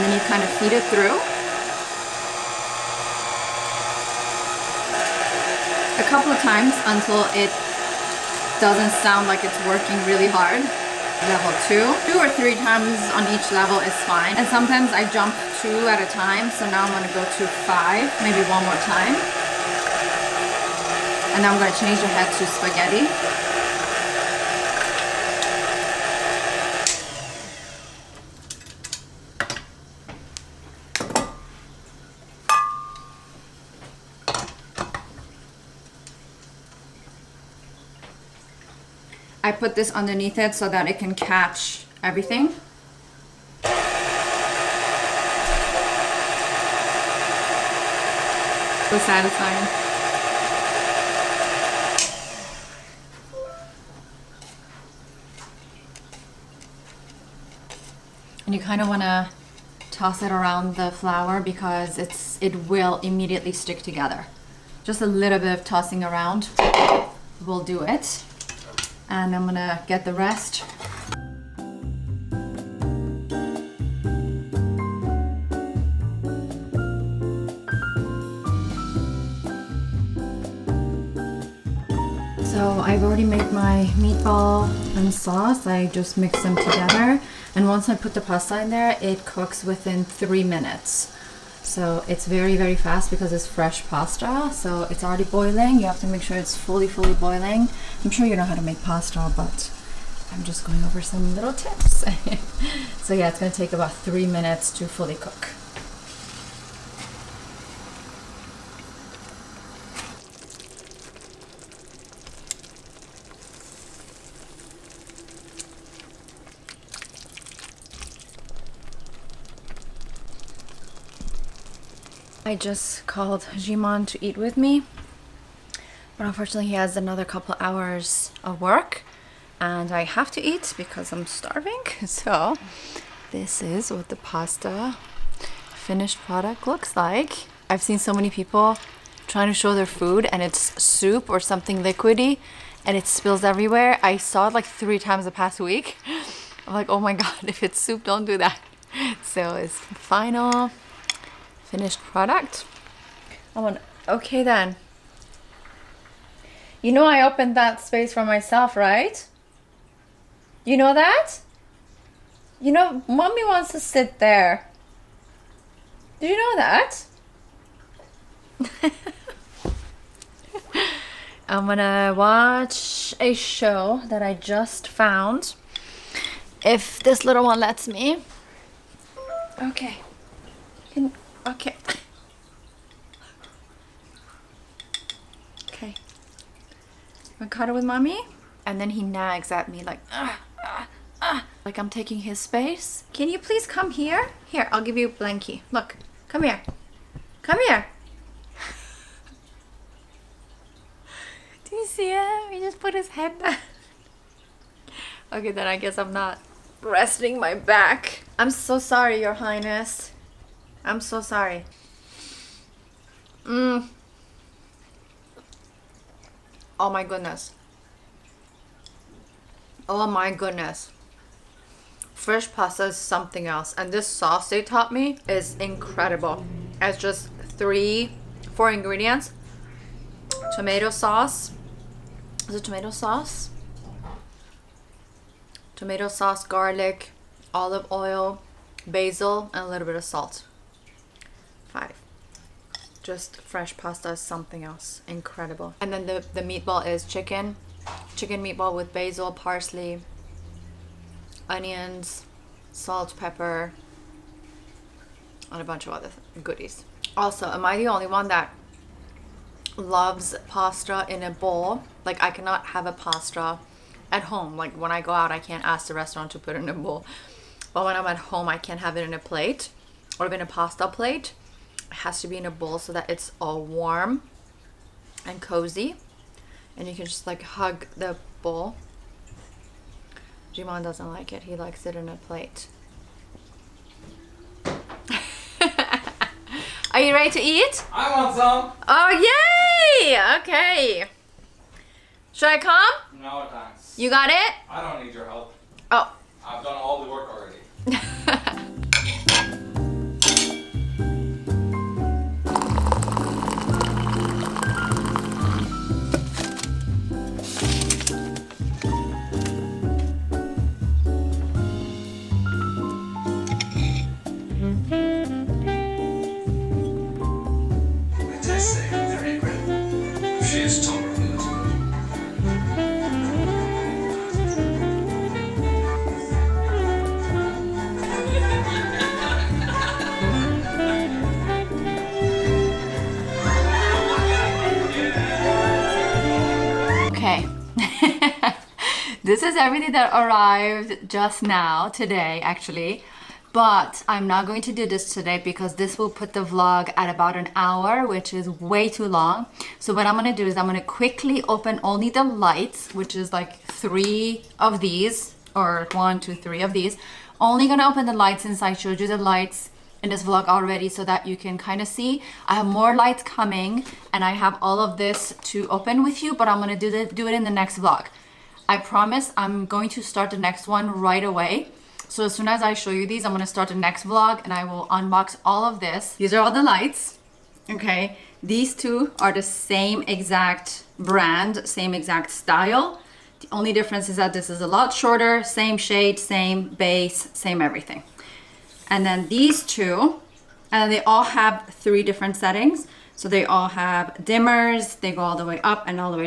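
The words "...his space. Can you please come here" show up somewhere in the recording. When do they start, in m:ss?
3:12.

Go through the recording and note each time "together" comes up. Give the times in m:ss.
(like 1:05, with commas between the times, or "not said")
1:03, 1:26.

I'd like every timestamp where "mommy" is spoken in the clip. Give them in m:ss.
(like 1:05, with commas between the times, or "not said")
2:43, 3:07.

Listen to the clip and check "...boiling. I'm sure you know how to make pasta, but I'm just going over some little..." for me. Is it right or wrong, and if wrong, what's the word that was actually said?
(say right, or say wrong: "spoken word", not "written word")
right.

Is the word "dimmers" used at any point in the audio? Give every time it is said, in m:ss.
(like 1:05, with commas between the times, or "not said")
6:34.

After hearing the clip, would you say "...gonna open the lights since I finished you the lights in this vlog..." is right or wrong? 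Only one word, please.
wrong.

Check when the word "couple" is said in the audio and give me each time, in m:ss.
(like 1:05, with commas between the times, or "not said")
0:06, 2:07.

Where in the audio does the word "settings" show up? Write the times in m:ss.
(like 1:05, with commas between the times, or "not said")
6:32.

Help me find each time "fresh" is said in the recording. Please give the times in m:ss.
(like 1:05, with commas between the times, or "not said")
1:33, 3:42, 4:03.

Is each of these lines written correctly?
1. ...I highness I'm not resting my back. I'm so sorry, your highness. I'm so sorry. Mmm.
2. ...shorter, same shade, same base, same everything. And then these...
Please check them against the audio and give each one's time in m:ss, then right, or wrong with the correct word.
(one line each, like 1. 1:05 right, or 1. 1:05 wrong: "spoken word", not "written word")
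1. 3:25 wrong: "guess", not "highness"
2. 6:24 right.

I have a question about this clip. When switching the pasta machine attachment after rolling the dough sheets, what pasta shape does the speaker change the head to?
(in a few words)
spaghetti.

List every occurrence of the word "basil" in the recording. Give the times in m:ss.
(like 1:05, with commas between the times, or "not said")
3:58, 4:08.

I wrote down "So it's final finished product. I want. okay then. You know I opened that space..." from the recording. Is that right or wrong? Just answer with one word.
right.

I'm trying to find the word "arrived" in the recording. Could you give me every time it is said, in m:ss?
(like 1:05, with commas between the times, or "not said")
5:40.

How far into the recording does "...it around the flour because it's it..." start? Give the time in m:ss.
1:00.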